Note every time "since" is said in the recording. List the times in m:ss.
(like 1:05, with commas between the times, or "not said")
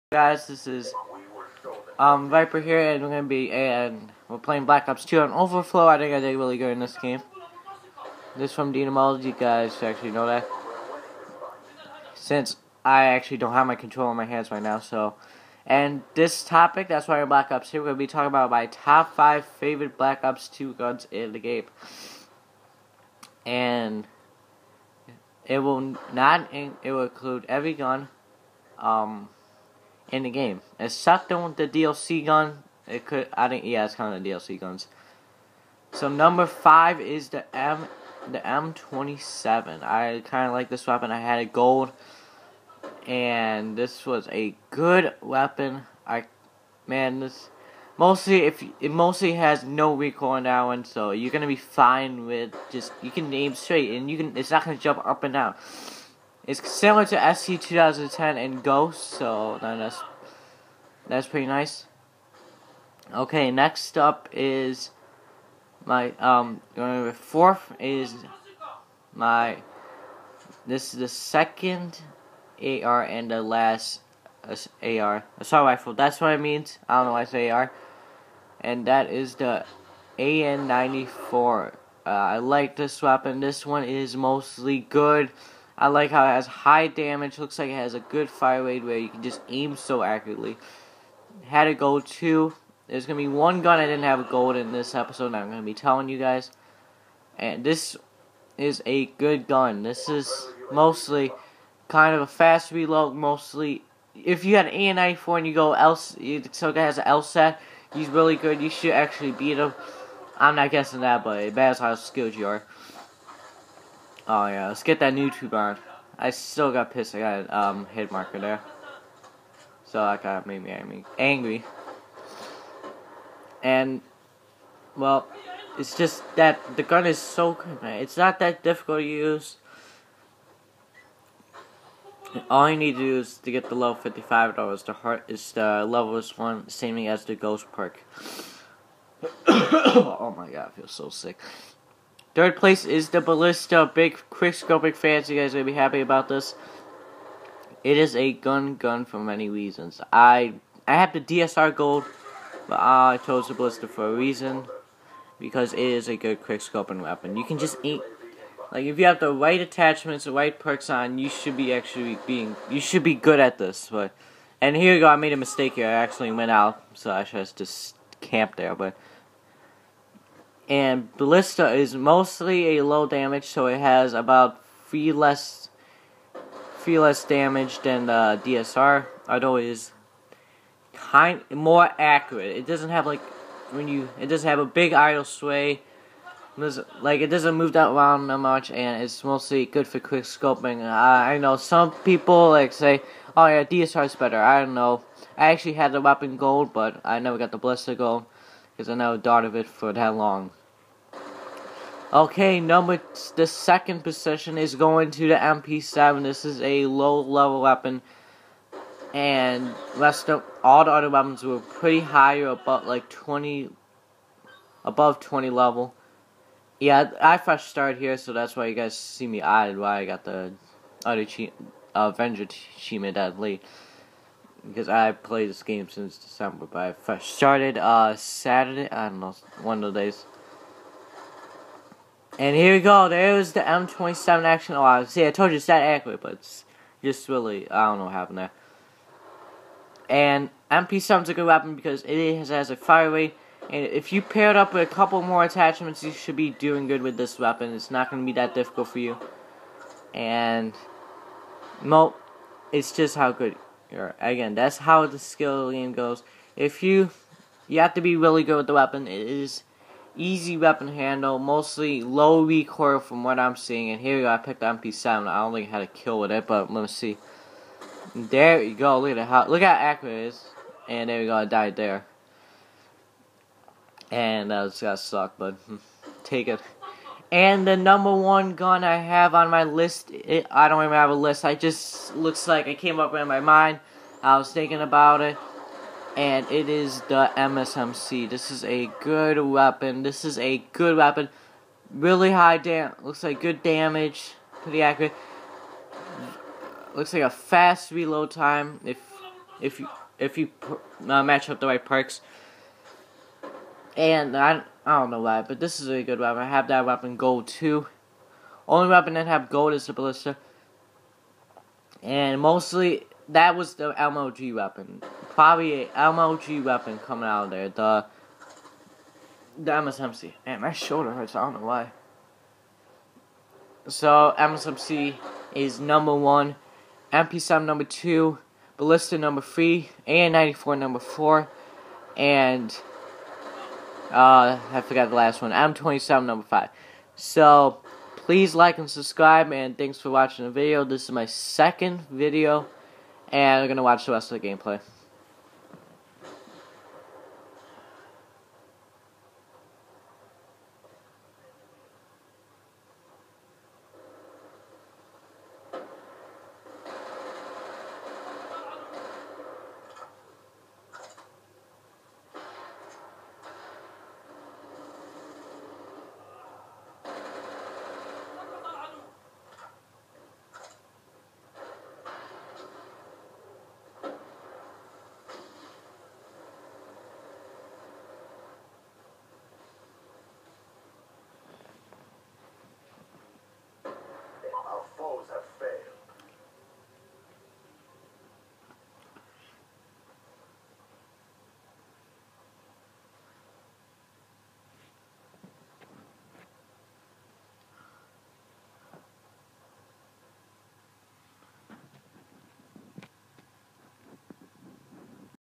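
0:12, 3:45.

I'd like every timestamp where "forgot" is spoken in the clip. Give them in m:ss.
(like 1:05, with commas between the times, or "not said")
5:34.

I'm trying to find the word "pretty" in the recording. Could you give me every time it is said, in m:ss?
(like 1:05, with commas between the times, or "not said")
1:01, 3:31, 4:54.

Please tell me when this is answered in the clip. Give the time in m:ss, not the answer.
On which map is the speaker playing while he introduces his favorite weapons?
0:05.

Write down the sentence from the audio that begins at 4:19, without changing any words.
It is easy weapon handle, mostly low recoil from what I'm seeing.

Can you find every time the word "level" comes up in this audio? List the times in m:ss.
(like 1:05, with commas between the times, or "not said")
2:13, 3:27, 3:35.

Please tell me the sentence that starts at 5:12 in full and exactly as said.
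And mostly that was the MLG weapon probably a MLG weapon coming out of there.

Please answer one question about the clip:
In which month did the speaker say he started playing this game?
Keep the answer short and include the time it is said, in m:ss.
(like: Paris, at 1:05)
December, at 3:46.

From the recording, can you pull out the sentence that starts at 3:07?
Like it doesn't move that around that much, and it's mostly good for quick scoping.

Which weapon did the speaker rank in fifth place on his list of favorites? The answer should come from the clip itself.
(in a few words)
M27.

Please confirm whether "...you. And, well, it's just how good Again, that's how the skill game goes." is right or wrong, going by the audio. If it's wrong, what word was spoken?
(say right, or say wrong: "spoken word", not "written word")
right.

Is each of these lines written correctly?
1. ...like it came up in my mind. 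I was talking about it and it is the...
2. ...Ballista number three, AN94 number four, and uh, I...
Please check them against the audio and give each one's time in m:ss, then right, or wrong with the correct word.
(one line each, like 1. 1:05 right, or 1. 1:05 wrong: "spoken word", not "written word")
1. 4:42 wrong: "thinking", not "talking"
2. 5:28 right.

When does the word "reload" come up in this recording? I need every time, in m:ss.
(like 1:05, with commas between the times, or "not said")
1:42, 4:57.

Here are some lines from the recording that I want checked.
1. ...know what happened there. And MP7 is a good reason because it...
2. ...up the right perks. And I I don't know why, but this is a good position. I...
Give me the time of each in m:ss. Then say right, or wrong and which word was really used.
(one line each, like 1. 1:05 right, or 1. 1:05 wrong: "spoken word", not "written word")
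1. 3:57 wrong: "weapon", not "reason"
2. 5:01 wrong: "weapon", not "position".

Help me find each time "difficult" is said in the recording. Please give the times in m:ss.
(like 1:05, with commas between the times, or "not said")
2:08, 4:08.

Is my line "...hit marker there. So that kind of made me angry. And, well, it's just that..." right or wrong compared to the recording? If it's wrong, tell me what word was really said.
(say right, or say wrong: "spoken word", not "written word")
right.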